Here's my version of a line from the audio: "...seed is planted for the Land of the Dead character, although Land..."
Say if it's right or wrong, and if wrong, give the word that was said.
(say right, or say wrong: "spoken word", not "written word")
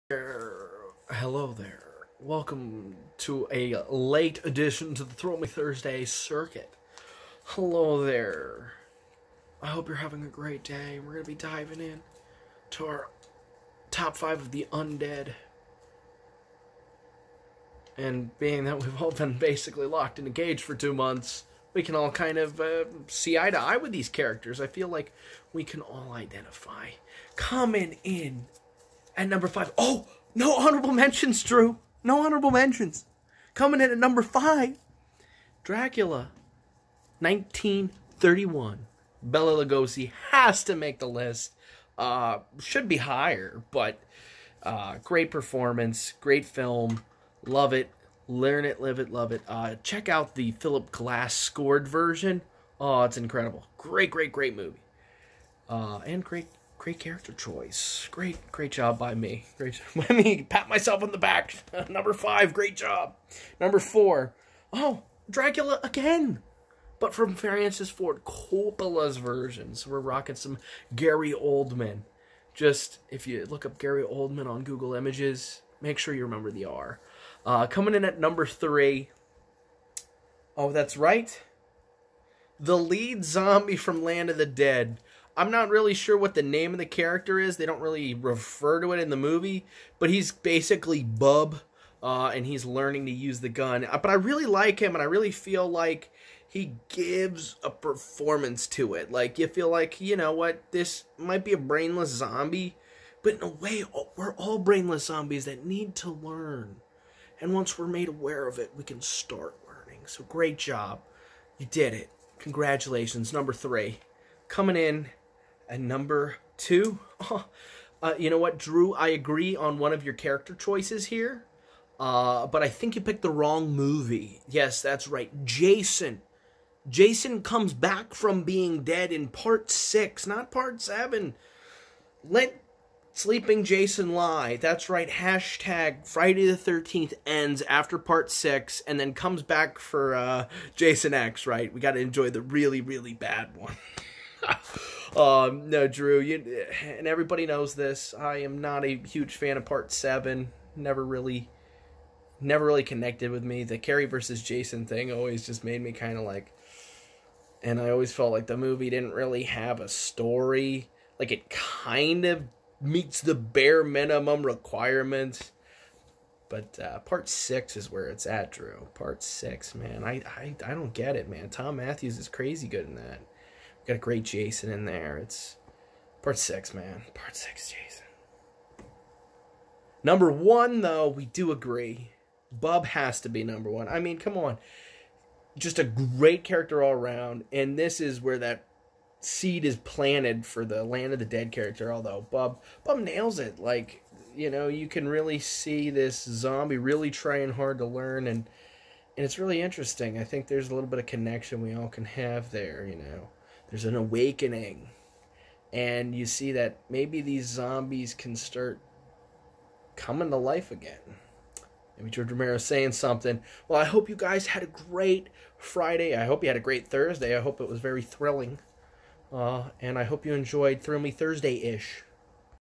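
wrong: "Bub", not "Land".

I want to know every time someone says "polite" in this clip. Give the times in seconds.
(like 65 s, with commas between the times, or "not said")
not said.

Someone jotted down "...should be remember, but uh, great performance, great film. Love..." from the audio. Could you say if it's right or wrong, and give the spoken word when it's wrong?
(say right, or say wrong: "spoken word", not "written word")
wrong: "higher", not "remember".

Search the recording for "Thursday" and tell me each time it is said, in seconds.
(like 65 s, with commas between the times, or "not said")
5 s, 216 s, 221 s.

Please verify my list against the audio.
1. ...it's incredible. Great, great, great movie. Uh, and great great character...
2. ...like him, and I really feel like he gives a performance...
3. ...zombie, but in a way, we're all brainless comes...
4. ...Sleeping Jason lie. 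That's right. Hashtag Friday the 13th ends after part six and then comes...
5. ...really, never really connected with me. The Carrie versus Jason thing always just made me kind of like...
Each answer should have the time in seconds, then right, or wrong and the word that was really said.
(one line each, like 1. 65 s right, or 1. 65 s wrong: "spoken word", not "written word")
1. 53 s right
2. 94 s right
3. 102 s wrong: "zombies", not "comes"
4. 133 s right
5. 151 s right.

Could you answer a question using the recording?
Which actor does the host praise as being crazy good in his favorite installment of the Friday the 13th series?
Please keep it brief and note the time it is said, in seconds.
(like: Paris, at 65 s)
Thom Mathews, at 171 s.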